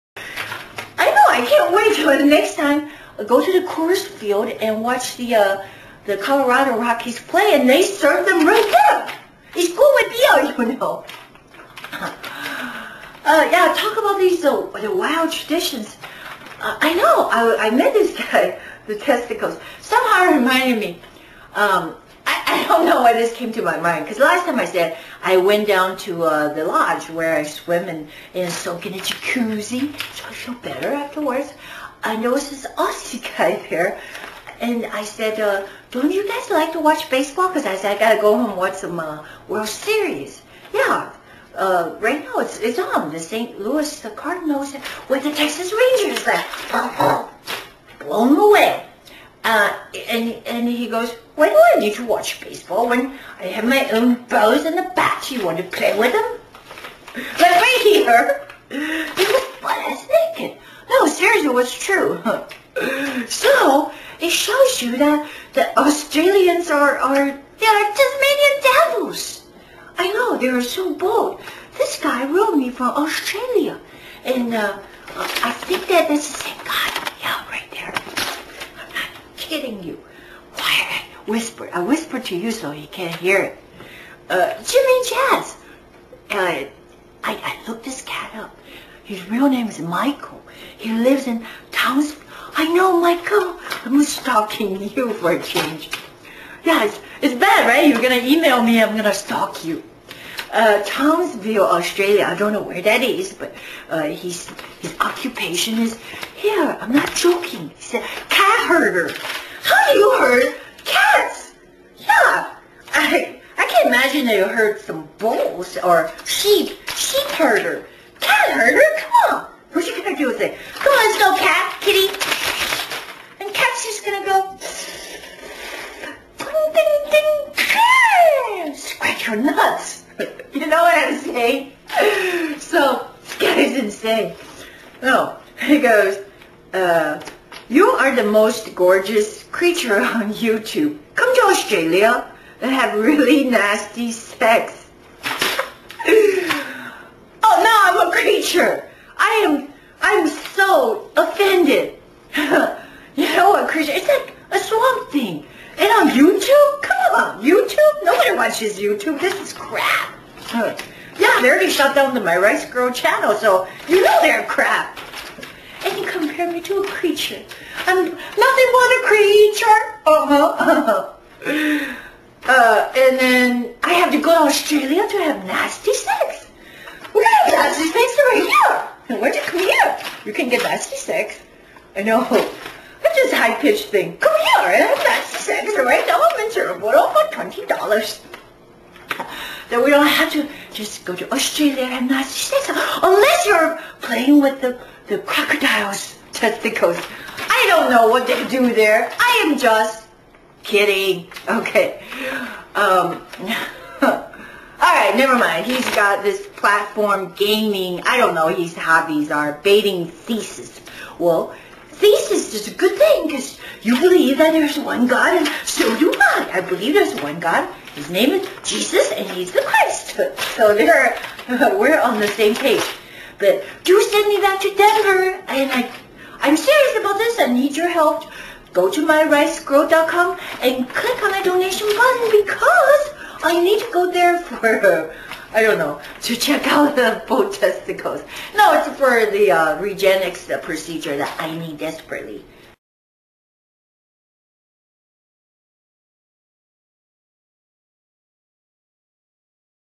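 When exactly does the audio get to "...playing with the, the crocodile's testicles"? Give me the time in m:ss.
3:14.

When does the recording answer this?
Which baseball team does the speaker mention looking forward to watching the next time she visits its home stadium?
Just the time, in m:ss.
0:06.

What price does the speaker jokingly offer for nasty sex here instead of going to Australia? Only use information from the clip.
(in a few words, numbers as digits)
$20.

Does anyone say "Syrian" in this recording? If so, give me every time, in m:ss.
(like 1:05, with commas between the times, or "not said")
not said.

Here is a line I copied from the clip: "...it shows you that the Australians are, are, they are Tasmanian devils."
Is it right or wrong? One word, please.
right.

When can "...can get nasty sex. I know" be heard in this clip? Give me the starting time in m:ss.
3:00.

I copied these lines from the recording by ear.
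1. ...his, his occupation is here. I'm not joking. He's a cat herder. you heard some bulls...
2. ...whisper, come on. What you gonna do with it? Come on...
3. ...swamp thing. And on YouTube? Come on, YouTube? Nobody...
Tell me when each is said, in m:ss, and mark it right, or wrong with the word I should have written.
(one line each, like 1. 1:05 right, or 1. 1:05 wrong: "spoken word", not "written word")
1. 1:44 right
2. 1:58 wrong: "herder", not "whisper"
3. 2:34 right.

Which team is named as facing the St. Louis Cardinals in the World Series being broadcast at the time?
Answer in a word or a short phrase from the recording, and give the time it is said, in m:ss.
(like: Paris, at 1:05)
Texas Rangers, at 0:45.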